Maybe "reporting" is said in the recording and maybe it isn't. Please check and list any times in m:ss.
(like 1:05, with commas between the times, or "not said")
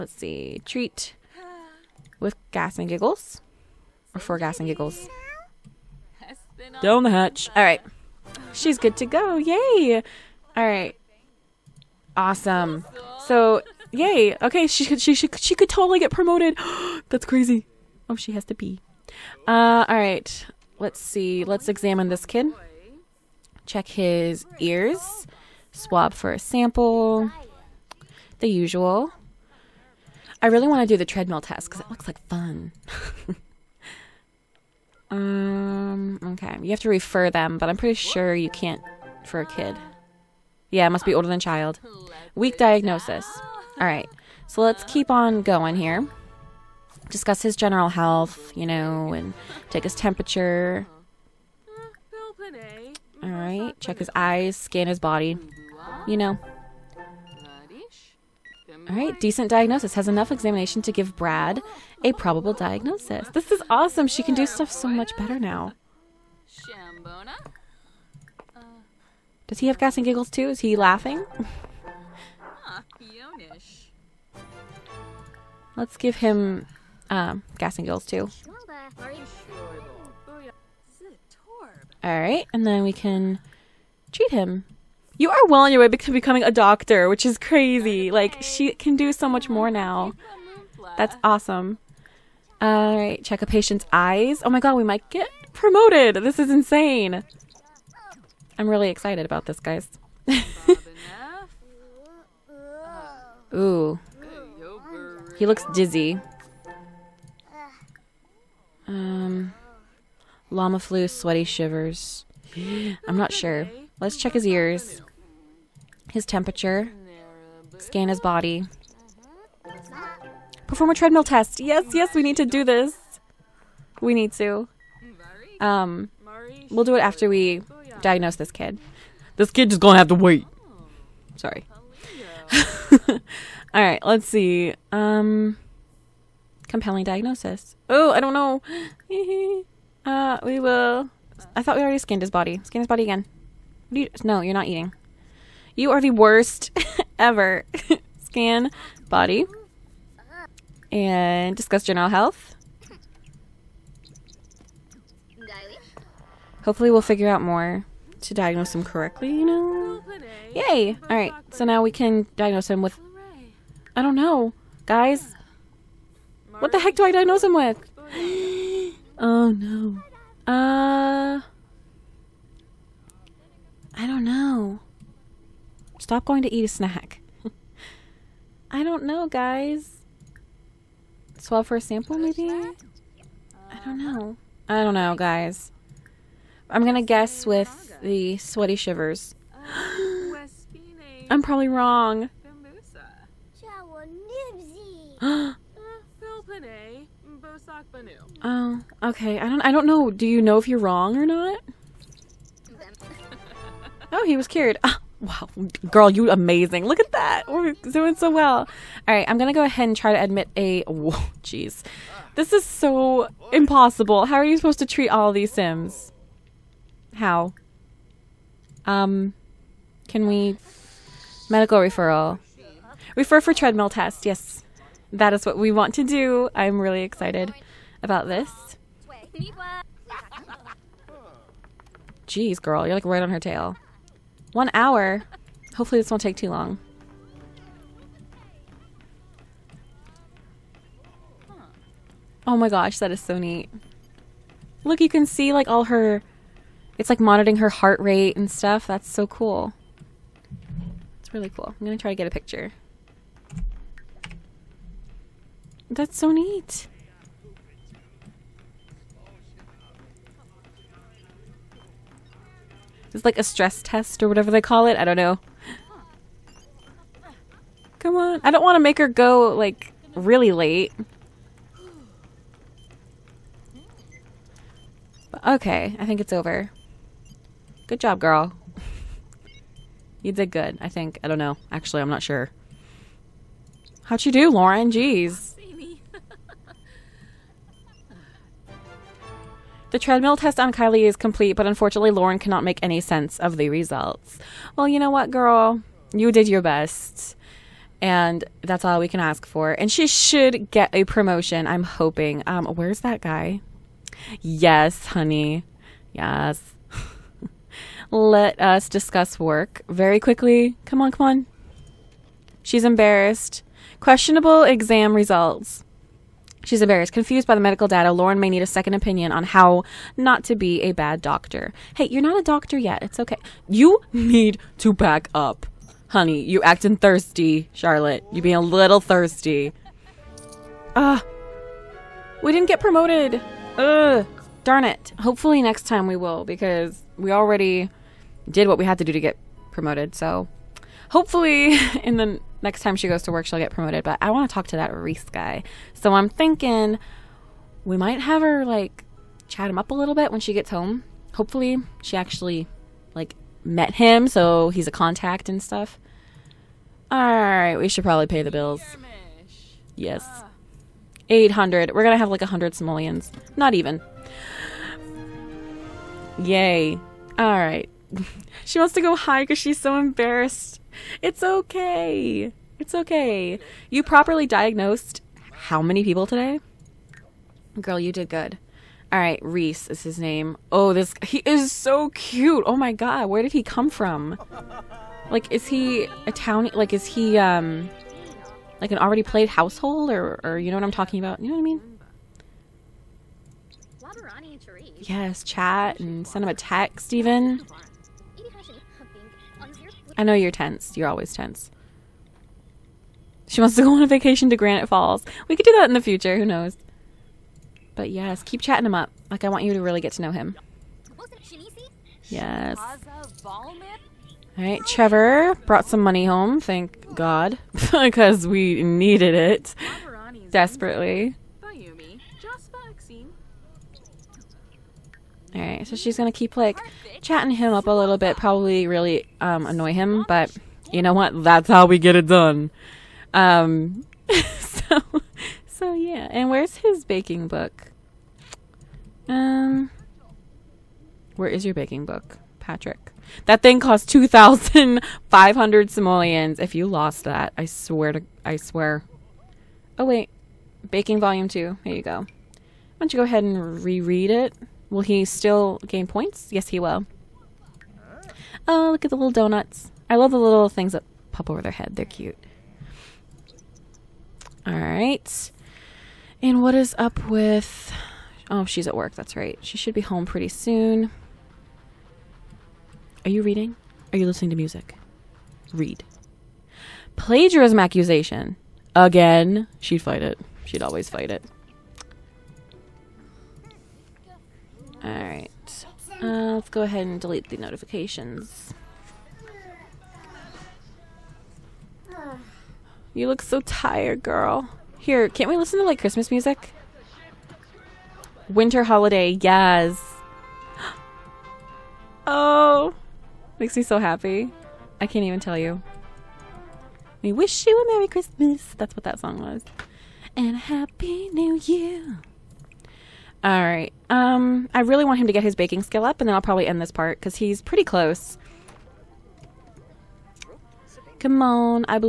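not said.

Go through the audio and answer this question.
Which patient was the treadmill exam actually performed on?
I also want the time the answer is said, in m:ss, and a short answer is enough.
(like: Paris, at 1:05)
Kylie, at 4:50.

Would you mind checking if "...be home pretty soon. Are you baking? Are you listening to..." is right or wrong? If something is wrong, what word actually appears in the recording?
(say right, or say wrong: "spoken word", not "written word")
wrong: "reading", not "baking".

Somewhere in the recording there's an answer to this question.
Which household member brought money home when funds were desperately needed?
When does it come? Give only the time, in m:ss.
6:54.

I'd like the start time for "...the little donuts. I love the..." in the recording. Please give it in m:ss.
7:39.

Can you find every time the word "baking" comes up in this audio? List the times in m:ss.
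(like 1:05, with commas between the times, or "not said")
7:17, 7:21, 7:30, 8:35.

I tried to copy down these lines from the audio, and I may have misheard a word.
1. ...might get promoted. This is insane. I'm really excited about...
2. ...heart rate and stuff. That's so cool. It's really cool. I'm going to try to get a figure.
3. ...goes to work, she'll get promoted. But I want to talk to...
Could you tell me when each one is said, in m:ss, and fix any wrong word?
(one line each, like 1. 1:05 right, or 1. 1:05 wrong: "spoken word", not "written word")
1. 1:34 right
2. 4:07 wrong: "picture", not "figure"
3. 5:43 right.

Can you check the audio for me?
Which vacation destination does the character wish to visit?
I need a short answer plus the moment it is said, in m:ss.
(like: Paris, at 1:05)
Granite Falls, at 6:44.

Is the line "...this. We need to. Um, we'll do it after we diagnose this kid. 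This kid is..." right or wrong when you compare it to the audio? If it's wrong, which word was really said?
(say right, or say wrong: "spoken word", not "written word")
right.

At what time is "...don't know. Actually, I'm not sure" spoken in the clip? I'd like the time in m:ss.
4:41.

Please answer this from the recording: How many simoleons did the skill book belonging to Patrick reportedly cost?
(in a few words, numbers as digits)
2500.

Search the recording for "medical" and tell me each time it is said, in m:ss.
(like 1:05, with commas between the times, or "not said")
3:41, 5:17.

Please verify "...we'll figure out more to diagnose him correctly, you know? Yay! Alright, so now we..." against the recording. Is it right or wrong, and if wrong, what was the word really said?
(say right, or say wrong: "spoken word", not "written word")
right.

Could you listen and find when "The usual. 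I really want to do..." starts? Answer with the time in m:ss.
0:28.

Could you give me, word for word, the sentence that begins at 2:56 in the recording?
Stop going to eat a snack.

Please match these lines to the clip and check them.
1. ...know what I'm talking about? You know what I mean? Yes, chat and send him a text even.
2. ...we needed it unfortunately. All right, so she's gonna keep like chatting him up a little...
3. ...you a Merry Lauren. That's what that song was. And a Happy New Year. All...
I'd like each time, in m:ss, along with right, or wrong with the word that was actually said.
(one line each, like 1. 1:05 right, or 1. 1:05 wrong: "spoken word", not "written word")
1. 6:30 right
2. 6:58 wrong: "desperately", not "unfortunately"
3. 8:27 wrong: "Christmas", not "Lauren".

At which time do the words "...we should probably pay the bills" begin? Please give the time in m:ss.
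5:57.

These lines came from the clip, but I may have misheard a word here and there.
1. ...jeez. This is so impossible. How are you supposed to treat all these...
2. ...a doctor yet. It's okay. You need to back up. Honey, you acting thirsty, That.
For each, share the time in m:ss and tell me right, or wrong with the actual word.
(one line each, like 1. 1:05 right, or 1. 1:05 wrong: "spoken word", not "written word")
1. 3:31 right
2. 5:22 wrong: "Charlotte", not "That".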